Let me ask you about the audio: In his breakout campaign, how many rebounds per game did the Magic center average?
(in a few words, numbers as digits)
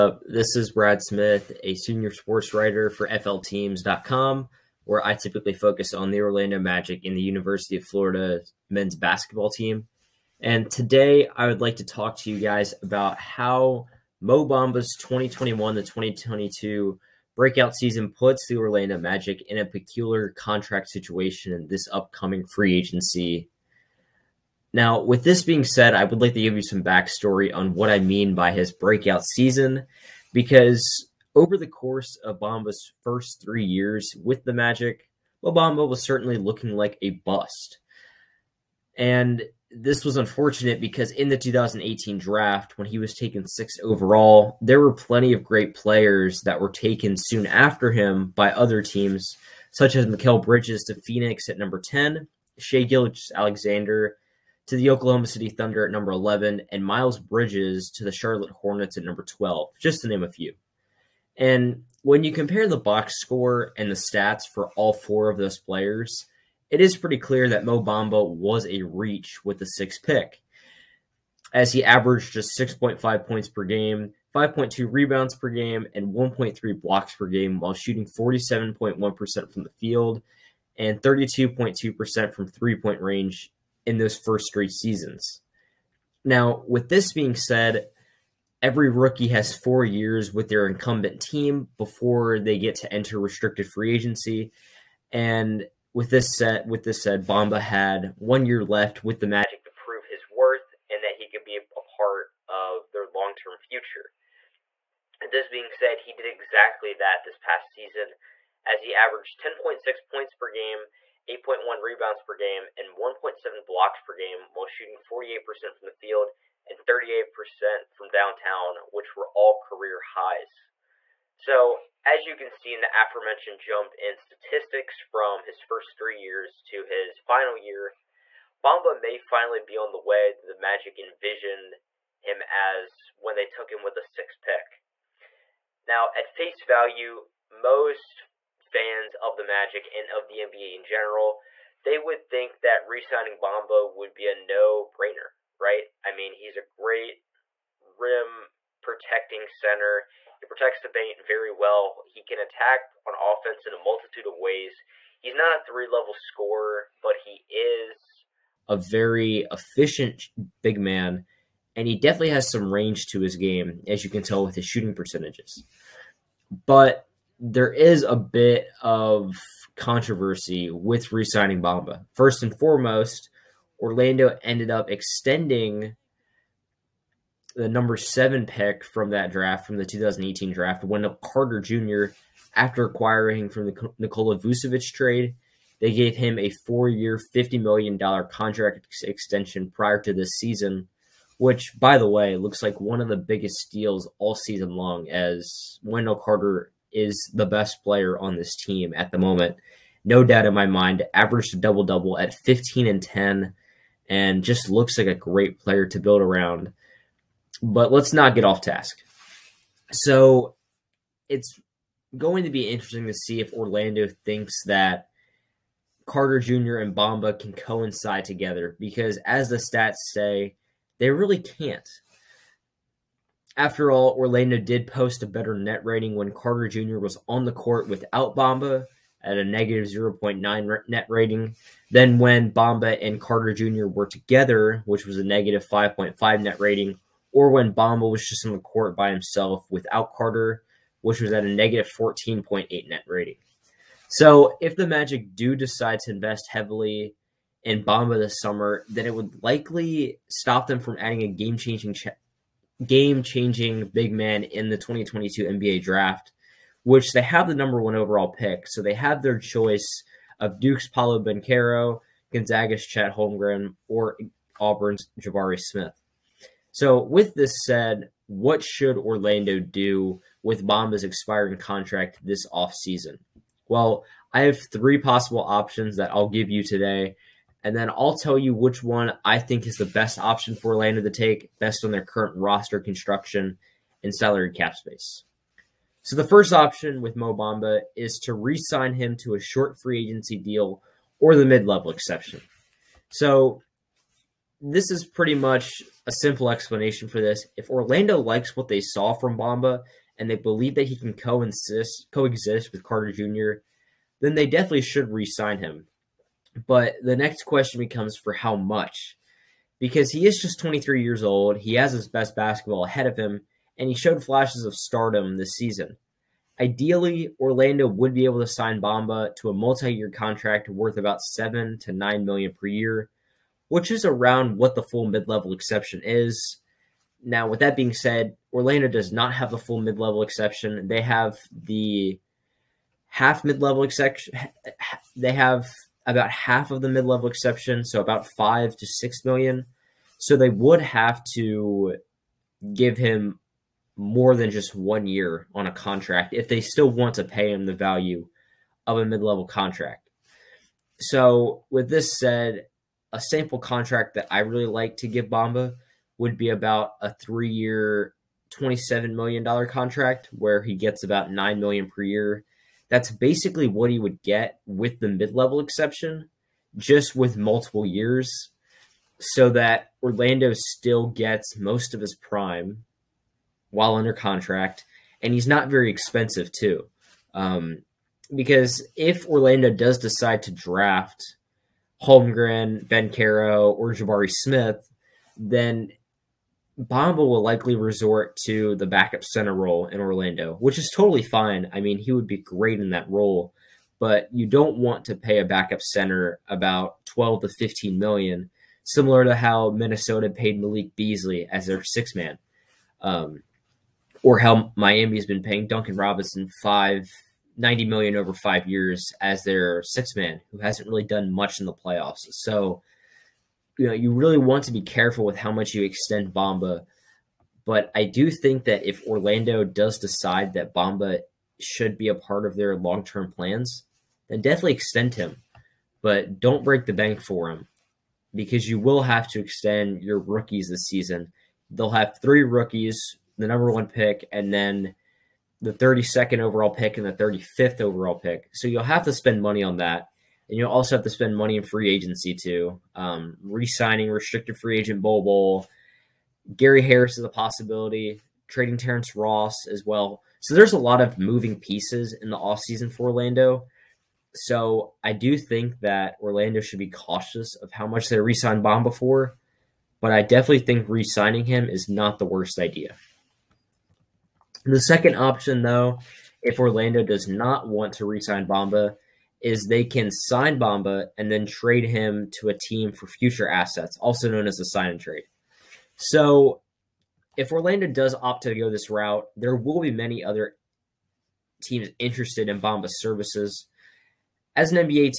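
8.1.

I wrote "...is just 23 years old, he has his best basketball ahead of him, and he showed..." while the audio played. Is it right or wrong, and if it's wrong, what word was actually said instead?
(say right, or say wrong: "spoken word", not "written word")
right.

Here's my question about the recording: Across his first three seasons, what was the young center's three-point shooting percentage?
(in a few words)
32.2%.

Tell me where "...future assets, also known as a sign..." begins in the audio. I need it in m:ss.
7:53.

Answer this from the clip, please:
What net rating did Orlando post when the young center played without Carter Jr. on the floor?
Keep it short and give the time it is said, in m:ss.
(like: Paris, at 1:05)
-14.8, at 4:01.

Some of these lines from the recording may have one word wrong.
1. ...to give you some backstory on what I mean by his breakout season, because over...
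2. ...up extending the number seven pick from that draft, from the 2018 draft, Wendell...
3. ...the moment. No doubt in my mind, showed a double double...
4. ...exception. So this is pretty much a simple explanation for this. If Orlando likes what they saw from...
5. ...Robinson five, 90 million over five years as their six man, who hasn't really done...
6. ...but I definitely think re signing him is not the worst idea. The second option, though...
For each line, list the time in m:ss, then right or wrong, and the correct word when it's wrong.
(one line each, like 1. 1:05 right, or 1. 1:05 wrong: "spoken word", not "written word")
1. 0:26 right
2. 2:54 right
3. 3:19 wrong: "averaged", not "showed"
4. 4:51 right
5. 6:45 right
6. 7:39 right.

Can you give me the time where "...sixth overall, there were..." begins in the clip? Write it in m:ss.
0:43.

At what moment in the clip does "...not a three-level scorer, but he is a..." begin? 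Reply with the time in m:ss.
2:35.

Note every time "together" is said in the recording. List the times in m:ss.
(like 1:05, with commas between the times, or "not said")
3:38, 3:54.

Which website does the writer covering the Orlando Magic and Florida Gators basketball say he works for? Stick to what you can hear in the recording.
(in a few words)
FLTeams.com.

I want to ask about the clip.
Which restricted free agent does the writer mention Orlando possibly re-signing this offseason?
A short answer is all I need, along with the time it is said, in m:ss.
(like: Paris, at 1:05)
Bol Bol, at 7:25.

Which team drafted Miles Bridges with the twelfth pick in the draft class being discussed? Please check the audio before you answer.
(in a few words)
Charlotte Hornets.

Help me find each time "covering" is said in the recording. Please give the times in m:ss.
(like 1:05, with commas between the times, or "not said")
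not said.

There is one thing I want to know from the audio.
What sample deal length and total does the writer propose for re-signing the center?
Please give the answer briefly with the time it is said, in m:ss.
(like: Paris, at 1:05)
3 years, $27 million, at 5:57.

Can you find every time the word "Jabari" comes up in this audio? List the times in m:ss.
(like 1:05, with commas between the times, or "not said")
4:25, 6:23.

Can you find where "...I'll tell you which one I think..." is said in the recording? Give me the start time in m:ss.
4:37.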